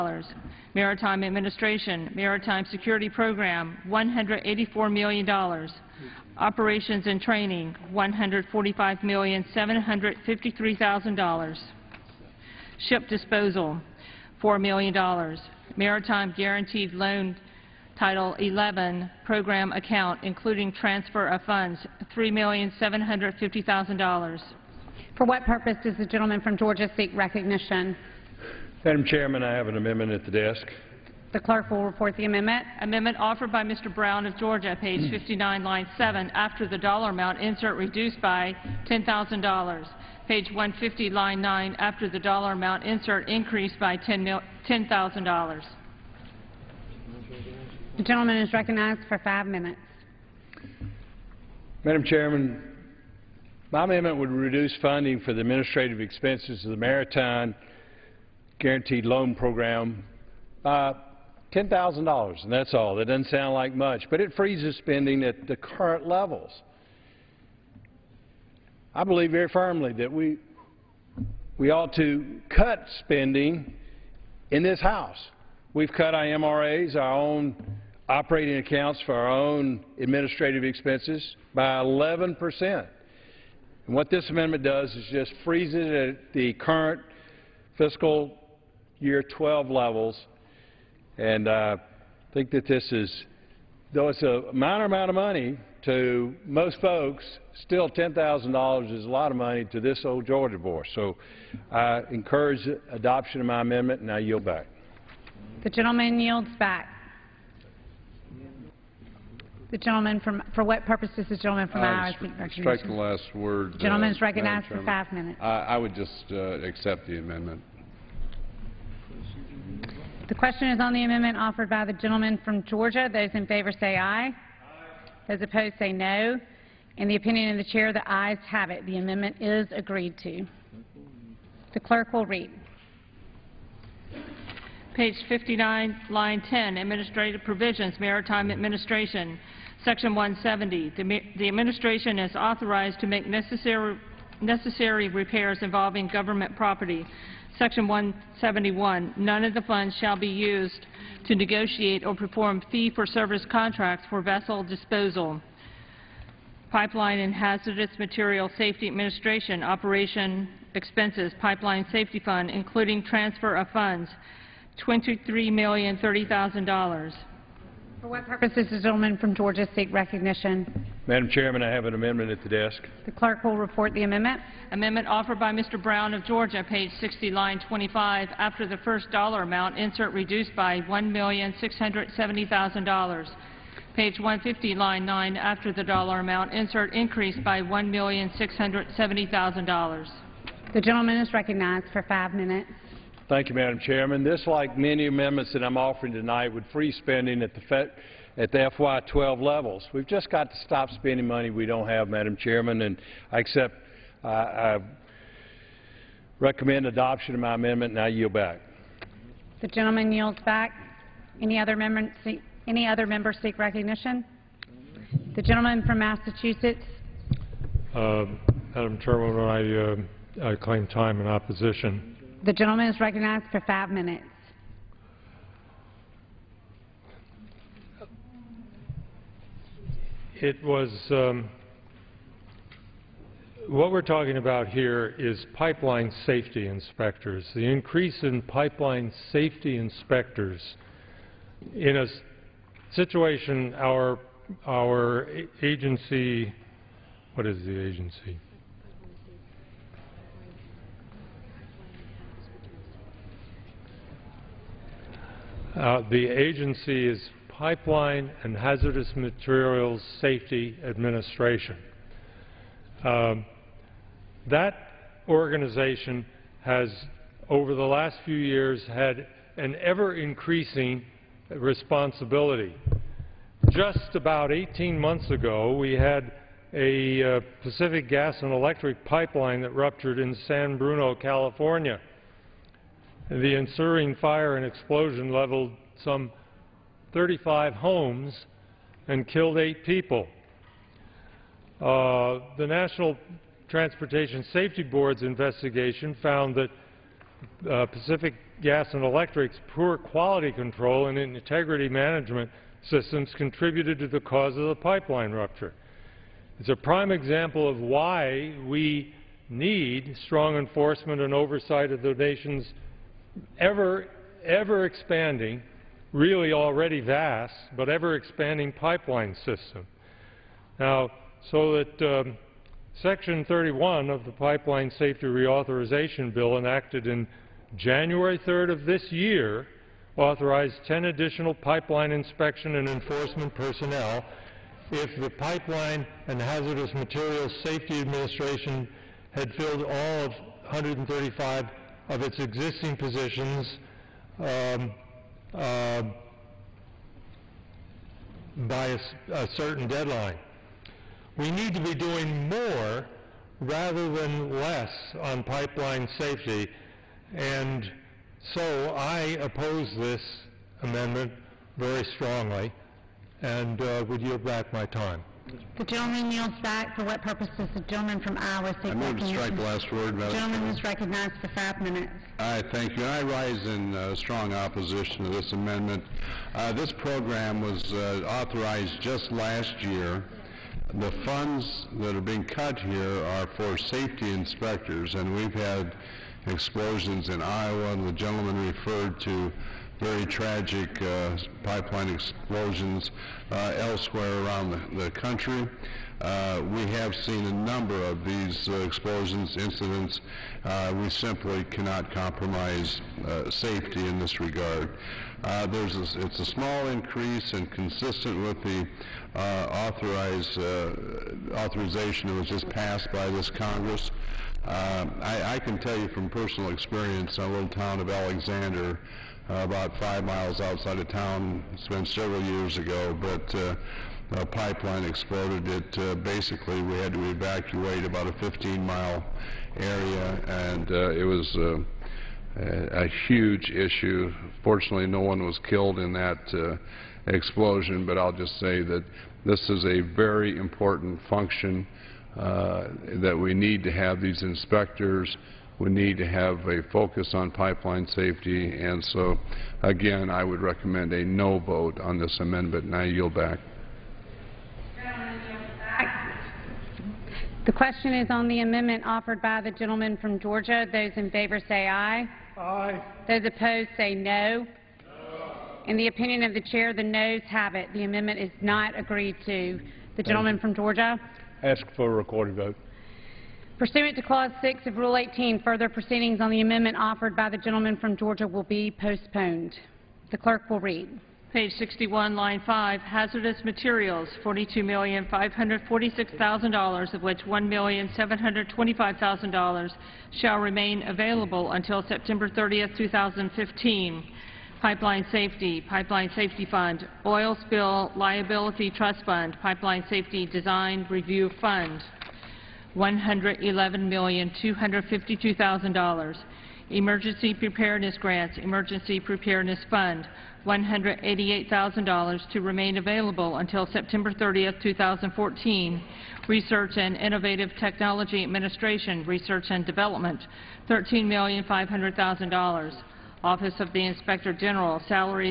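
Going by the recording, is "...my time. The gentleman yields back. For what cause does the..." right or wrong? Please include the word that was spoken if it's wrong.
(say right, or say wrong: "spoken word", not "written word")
wrong: "purpose", not "cause".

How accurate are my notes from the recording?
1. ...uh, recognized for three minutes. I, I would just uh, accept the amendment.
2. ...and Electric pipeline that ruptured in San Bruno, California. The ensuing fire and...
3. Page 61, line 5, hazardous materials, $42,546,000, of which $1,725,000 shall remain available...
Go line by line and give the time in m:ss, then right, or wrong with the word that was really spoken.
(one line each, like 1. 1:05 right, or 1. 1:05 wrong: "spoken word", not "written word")
1. 1:54 wrong: "five", not "three"
2. 4:38 right
3. 8:01 right.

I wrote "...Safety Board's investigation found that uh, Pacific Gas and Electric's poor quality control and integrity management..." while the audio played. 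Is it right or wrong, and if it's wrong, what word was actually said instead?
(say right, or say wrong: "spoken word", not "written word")
right.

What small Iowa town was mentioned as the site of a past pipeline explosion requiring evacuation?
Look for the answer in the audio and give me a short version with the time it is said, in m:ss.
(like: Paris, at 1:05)
Alexander, at 6:58.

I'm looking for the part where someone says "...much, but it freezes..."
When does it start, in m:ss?
1:03.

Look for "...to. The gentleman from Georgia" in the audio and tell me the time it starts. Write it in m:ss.
7:49.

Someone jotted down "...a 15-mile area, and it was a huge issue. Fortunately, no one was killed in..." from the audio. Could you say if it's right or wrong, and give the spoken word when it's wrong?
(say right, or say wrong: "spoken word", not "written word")
right.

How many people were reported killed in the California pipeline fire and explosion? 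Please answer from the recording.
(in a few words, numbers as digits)
8.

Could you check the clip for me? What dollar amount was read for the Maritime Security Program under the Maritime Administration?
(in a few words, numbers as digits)
$184 million.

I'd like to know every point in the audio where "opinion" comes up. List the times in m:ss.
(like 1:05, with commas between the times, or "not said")
2:07, 7:46.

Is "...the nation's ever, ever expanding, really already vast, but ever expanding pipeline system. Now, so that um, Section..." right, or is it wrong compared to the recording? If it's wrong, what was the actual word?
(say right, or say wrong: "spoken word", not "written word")
right.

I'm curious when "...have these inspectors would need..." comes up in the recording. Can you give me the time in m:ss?
7:23.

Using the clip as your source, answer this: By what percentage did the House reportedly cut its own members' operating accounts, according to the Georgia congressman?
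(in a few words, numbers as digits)
11 percent.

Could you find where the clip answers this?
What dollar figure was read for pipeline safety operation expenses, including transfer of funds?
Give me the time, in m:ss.
2:44.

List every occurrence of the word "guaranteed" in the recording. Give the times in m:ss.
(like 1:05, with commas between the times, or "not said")
0:16, 0:58.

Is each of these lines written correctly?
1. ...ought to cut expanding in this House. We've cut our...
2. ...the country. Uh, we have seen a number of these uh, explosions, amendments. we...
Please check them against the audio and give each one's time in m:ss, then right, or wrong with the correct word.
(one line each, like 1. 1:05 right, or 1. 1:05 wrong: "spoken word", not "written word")
1. 1:11 wrong: "spending", not "expanding"
2. 6:35 wrong: "incidents", not "amendments".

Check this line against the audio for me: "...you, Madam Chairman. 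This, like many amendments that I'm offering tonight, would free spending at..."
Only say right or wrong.
right.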